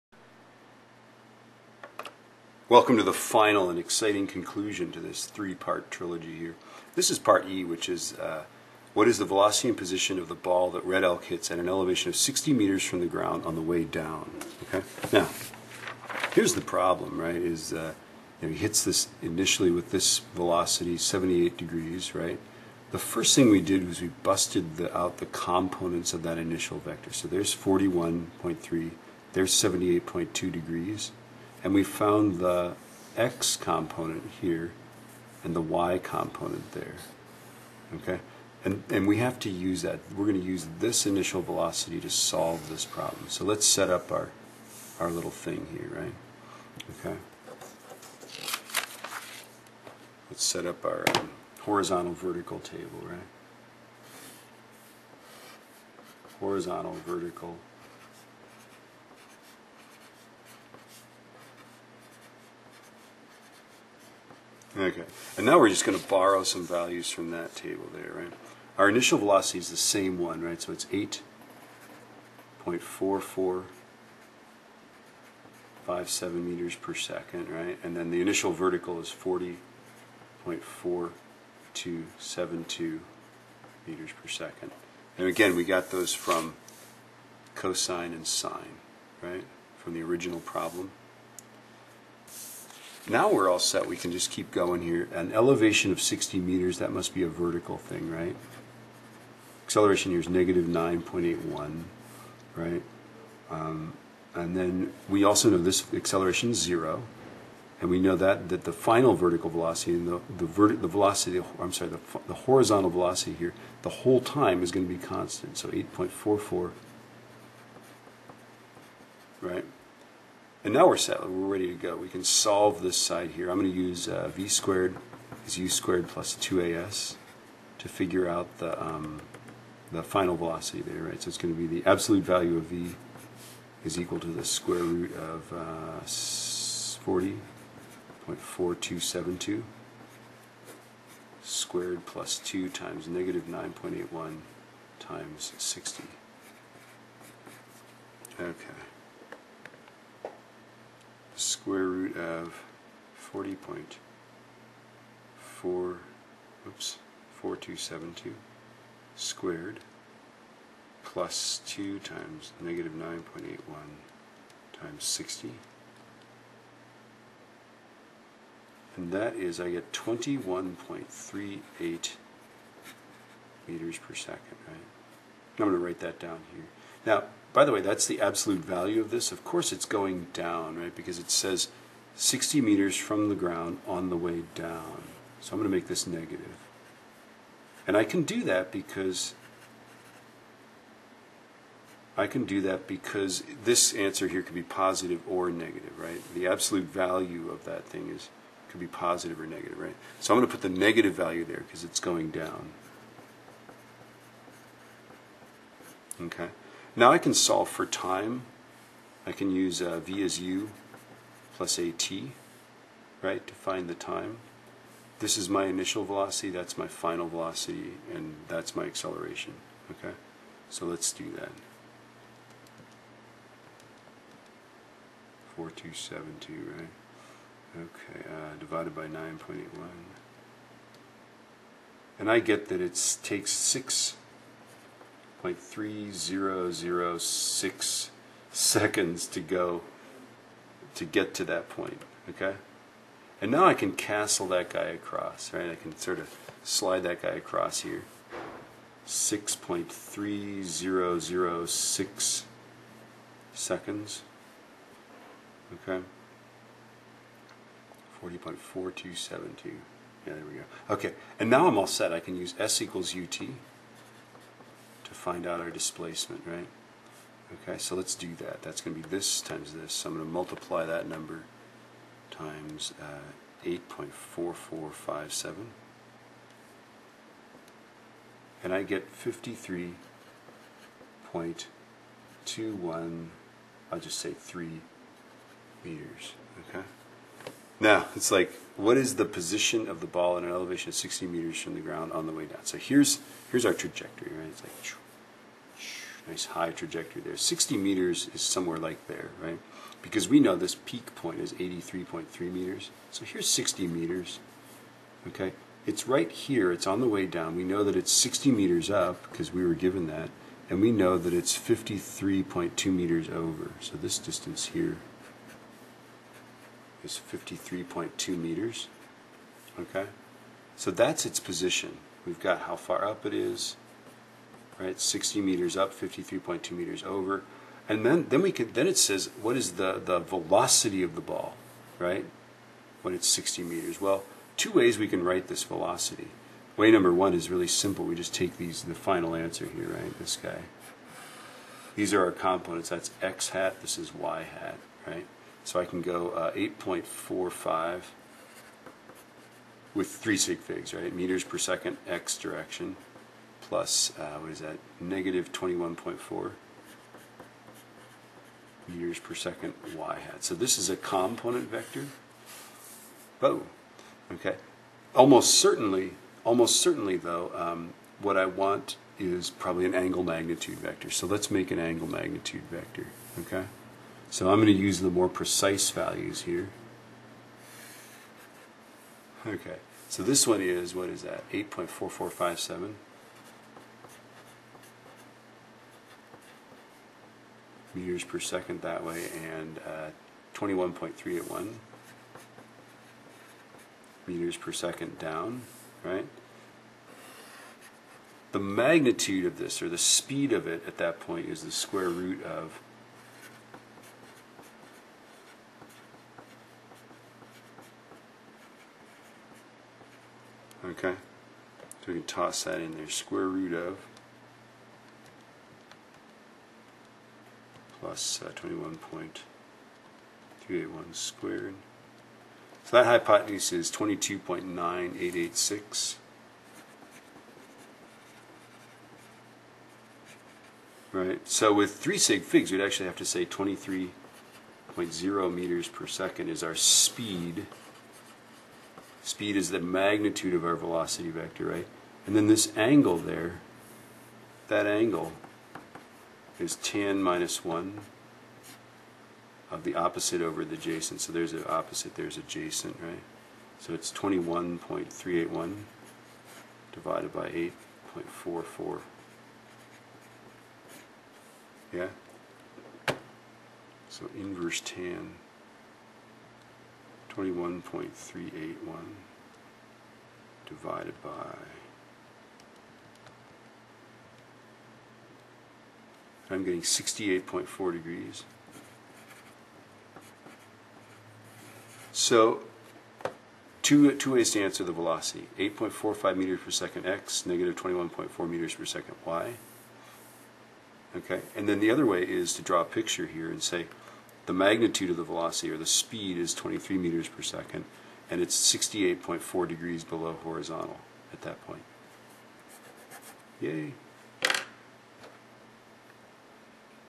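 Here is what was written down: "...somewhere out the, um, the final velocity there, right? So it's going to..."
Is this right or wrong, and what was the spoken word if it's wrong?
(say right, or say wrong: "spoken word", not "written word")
wrong: "figure", not "somewhere".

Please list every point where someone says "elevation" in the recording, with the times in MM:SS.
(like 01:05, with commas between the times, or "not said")
00:11, 01:35, 04:50.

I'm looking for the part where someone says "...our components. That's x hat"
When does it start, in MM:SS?
05:42.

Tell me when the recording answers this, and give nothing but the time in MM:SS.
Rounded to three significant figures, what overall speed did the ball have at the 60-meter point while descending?
07:13.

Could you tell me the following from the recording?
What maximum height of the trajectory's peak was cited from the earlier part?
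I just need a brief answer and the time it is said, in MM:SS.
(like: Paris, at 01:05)
83.3 meters, at 05:01.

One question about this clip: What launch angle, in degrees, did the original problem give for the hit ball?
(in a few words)
78.2 degrees.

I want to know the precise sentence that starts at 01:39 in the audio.
Acceleration here is negative 9.81, right?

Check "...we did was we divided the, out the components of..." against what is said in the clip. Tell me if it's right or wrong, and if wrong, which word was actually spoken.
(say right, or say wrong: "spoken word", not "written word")
wrong: "busted", not "divided".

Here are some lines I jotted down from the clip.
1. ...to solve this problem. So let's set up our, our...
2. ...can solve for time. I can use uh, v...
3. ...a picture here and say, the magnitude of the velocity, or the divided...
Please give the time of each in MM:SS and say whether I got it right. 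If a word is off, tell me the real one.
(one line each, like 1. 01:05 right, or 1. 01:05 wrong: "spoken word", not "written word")
1. 00:41 right
2. 03:27 right
3. 08:12 wrong: "speed", not "divided".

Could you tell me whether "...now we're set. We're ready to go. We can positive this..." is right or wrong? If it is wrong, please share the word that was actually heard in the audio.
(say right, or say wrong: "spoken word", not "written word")
wrong: "solve", not "positive".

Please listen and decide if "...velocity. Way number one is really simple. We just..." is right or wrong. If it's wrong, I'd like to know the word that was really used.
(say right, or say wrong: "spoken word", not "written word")
right.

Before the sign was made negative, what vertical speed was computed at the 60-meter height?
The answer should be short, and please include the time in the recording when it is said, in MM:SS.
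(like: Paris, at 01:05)
21.38 m/s, at 02:49.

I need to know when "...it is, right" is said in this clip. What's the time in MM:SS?
05:23.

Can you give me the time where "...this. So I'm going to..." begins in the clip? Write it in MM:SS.
04:29.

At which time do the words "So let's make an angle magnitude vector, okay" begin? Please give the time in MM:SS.
06:11.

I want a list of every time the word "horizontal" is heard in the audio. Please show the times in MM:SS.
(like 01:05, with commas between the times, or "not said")
00:51, 00:56, 01:52, 08:20.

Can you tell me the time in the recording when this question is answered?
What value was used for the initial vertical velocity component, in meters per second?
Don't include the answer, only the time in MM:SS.
01:20.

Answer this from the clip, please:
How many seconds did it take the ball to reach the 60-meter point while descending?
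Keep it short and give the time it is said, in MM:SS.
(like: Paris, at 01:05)
6.3006 seconds, at 04:09.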